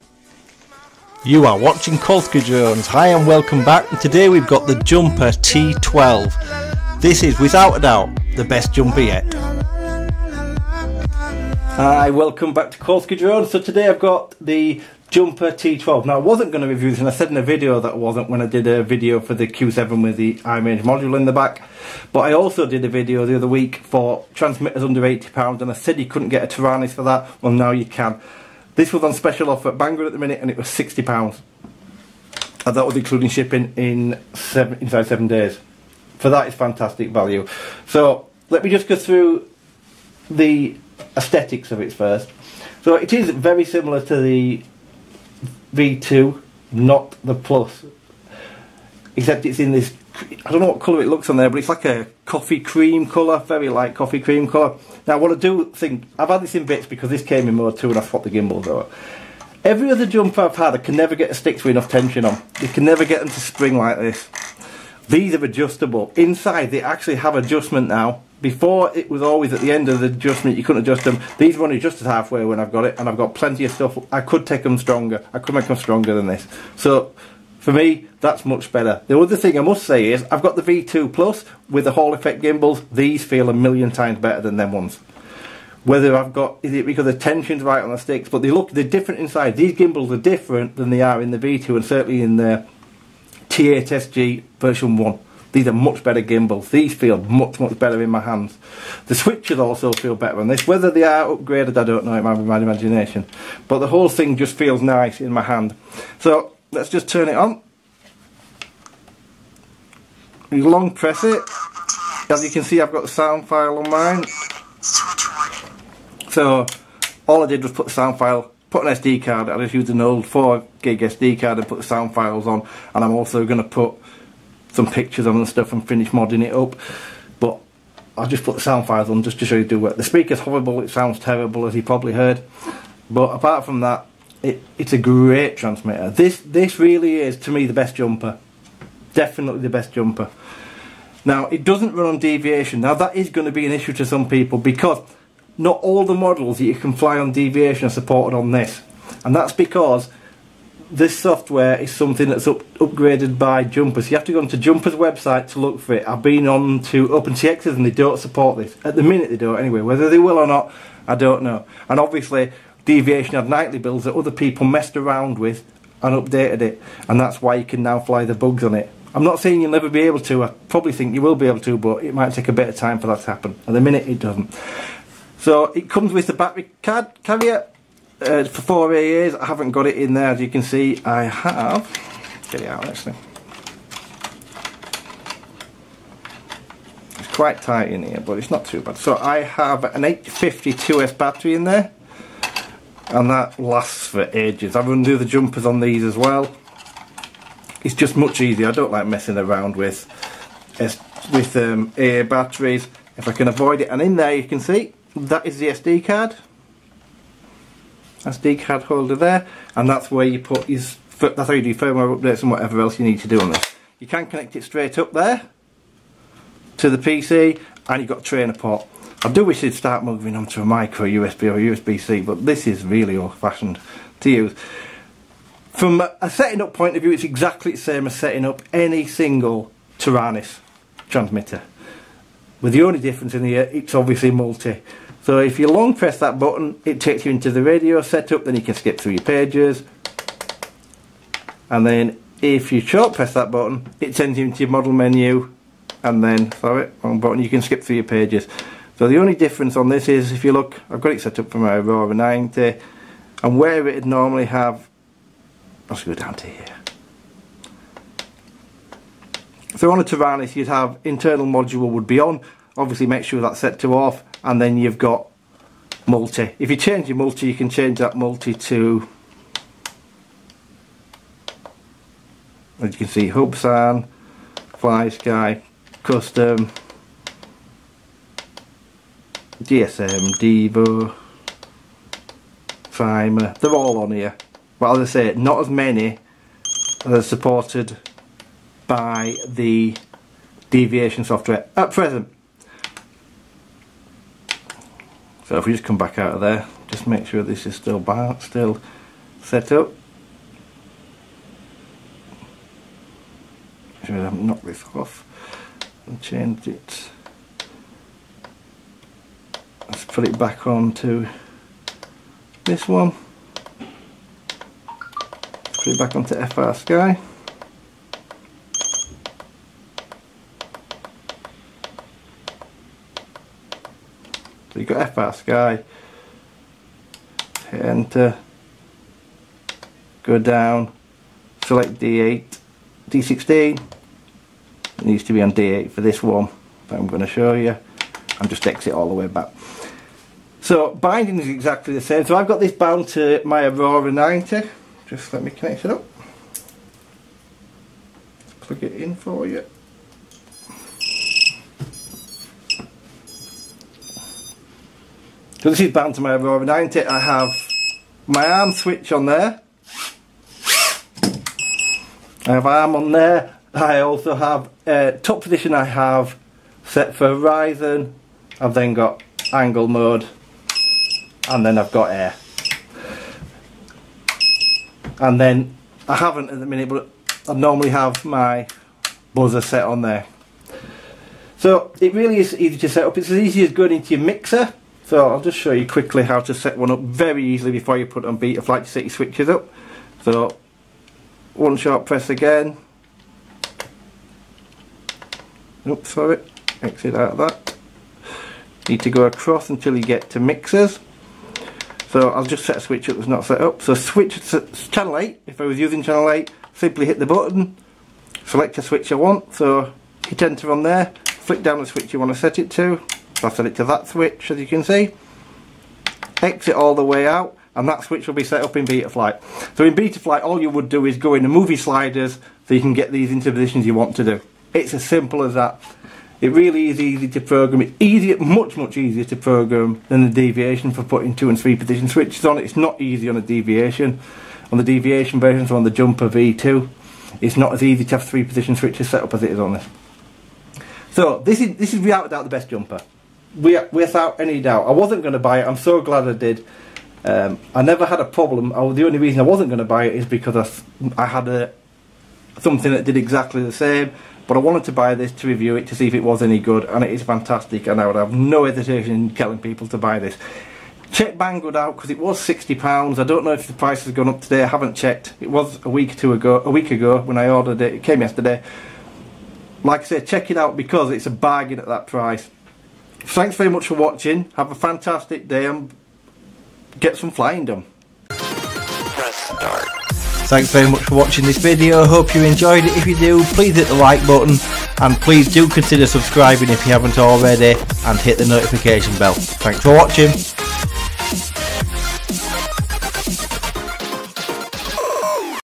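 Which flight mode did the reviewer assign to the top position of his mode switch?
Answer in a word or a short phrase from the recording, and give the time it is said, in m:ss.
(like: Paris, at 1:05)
horizon, at 6:07.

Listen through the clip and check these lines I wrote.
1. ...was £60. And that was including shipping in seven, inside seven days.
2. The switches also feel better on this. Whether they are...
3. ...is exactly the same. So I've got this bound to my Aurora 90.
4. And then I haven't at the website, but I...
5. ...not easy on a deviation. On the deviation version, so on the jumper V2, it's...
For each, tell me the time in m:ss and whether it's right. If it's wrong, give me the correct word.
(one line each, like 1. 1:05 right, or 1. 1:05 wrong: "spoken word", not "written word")
1. 0:30 right
2. 1:39 right
3. 5:41 right
4. 6:15 wrong: "minute", not "website"
5. 7:12 right.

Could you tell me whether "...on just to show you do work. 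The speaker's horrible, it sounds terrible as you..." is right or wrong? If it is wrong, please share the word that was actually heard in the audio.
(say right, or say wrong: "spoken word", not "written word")
right.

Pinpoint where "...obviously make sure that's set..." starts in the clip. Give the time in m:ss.
4:22.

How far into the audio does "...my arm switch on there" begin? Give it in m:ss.
5:58.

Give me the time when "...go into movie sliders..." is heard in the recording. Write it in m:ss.
7:01.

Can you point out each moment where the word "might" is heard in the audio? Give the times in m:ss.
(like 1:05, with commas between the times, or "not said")
1:42, 2:52.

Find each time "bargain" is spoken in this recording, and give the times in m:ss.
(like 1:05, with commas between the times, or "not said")
7:51.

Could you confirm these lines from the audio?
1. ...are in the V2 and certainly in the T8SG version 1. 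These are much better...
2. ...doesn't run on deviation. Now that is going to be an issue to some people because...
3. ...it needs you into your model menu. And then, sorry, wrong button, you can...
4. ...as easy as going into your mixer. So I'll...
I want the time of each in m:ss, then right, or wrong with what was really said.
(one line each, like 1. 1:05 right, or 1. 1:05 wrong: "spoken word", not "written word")
1. 1:31 right
2. 2:21 right
3. 4:04 wrong: "sends", not "needs"
4. 6:23 right.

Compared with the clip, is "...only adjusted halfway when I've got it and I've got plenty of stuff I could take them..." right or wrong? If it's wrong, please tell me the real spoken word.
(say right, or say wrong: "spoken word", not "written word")
right.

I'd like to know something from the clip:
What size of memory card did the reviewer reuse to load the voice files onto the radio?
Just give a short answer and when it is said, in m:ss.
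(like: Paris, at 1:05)
4 gig, at 2:00.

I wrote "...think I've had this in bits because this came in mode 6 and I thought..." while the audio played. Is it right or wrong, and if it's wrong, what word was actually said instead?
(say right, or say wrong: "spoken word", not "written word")
wrong: "2", not "6".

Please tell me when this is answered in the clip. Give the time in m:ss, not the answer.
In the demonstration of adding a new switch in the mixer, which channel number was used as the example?
6:43.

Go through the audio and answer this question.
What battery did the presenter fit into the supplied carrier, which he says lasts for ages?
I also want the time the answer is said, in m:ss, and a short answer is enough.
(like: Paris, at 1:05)
850 2S, at 3:10.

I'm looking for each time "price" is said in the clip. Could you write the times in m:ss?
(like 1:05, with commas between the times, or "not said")
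7:43, 7:52.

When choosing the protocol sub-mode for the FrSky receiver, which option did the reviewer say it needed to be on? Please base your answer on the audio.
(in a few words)
D8.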